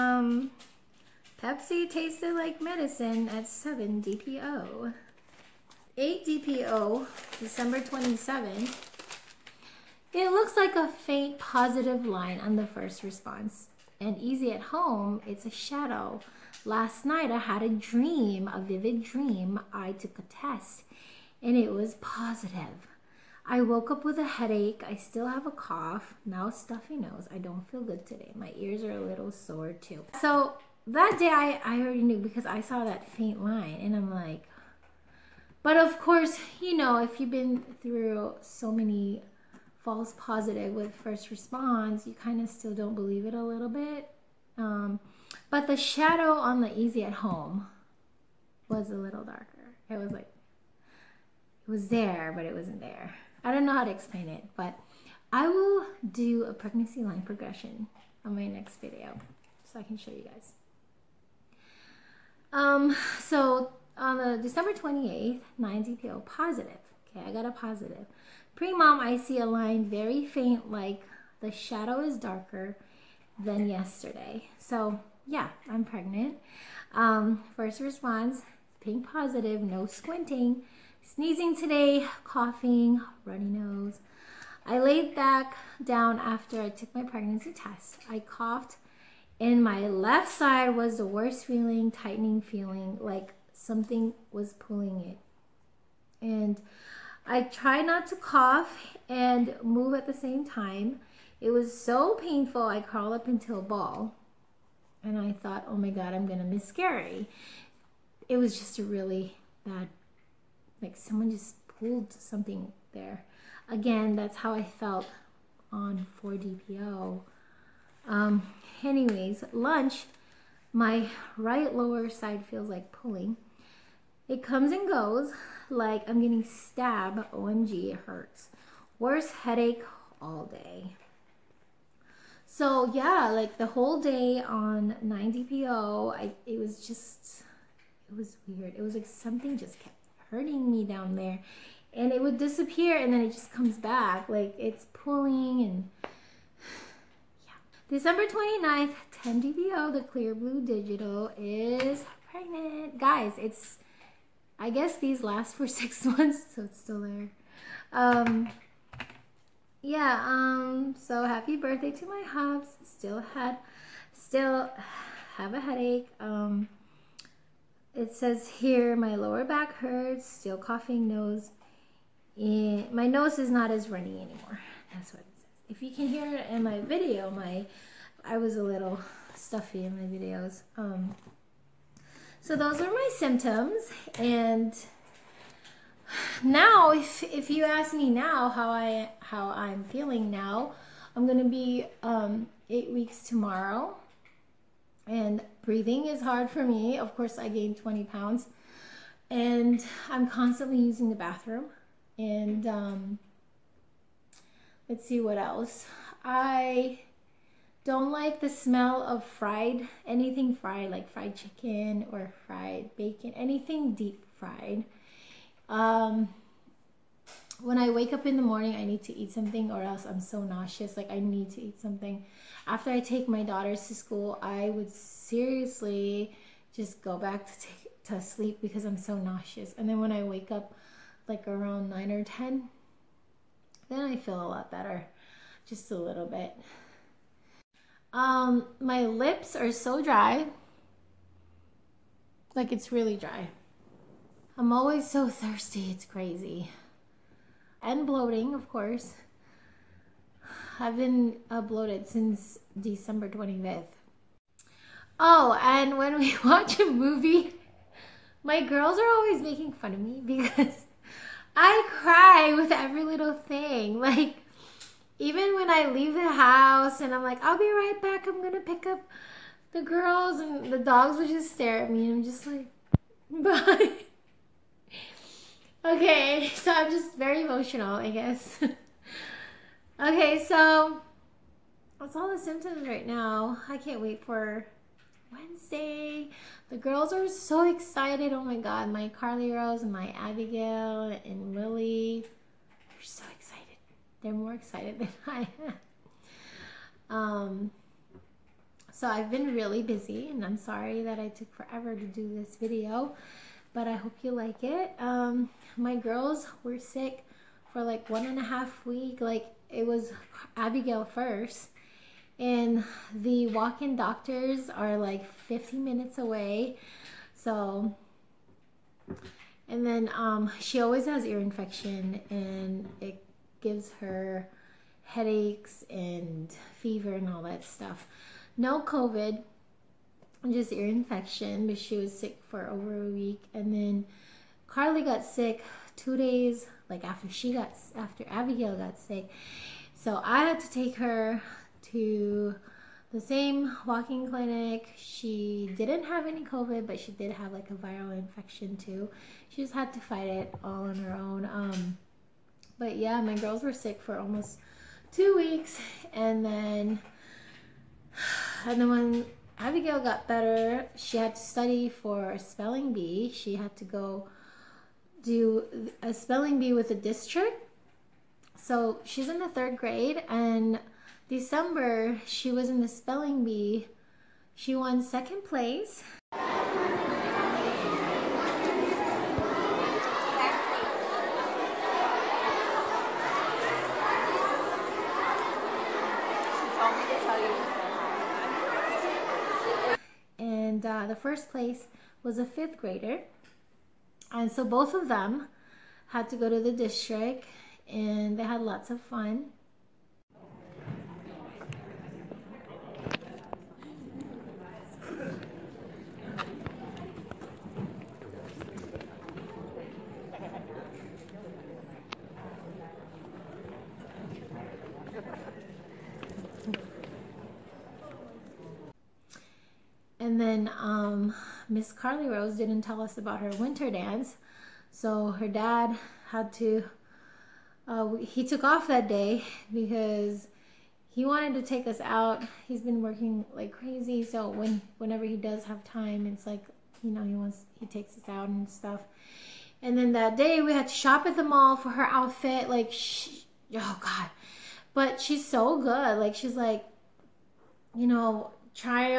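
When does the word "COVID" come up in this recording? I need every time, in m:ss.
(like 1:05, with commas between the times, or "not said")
5:28, 5:46.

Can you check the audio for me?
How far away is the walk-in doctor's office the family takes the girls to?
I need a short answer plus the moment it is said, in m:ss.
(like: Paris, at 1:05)
15 minutes, at 5:15.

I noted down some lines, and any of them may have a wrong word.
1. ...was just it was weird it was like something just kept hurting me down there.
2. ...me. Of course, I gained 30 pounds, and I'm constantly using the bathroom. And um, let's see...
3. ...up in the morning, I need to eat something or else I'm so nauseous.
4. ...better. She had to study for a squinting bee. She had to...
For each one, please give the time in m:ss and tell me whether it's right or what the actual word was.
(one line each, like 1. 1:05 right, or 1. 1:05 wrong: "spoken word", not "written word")
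1. 2:16 right
2. 3:16 wrong: "20", not "30"
3. 3:38 right
4. 6:00 wrong: "spelling", not "squinting".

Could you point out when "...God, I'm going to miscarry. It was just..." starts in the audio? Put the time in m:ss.
1:45.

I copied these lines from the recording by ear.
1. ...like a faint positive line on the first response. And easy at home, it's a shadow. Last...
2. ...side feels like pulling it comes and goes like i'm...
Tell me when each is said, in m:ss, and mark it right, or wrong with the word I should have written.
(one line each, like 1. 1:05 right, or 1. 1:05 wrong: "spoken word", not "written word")
1. 0:10 right
2. 2:02 right.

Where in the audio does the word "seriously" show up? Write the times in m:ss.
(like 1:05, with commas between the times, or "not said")
3:44.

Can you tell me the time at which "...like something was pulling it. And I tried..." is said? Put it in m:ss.
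1:33.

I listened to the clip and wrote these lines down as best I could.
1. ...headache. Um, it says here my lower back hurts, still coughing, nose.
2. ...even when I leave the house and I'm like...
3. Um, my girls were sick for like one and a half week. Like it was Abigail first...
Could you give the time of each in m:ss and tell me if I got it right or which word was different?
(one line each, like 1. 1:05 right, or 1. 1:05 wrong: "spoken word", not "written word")
1. 2:45 right
2. 4:25 right
3. 5:04 right.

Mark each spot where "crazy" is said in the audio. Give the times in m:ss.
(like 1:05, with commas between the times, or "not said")
4:06, 7:13.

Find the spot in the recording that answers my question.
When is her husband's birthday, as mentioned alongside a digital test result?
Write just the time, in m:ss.
2:27.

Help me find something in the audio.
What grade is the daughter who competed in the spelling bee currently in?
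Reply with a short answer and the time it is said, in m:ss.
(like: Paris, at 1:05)
Third grade, at 6:09.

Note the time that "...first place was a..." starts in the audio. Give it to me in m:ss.
6:31.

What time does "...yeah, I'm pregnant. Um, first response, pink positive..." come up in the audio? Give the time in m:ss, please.
1:15.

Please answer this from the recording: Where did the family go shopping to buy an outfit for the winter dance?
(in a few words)
The mall.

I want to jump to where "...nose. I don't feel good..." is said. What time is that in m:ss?
0:26.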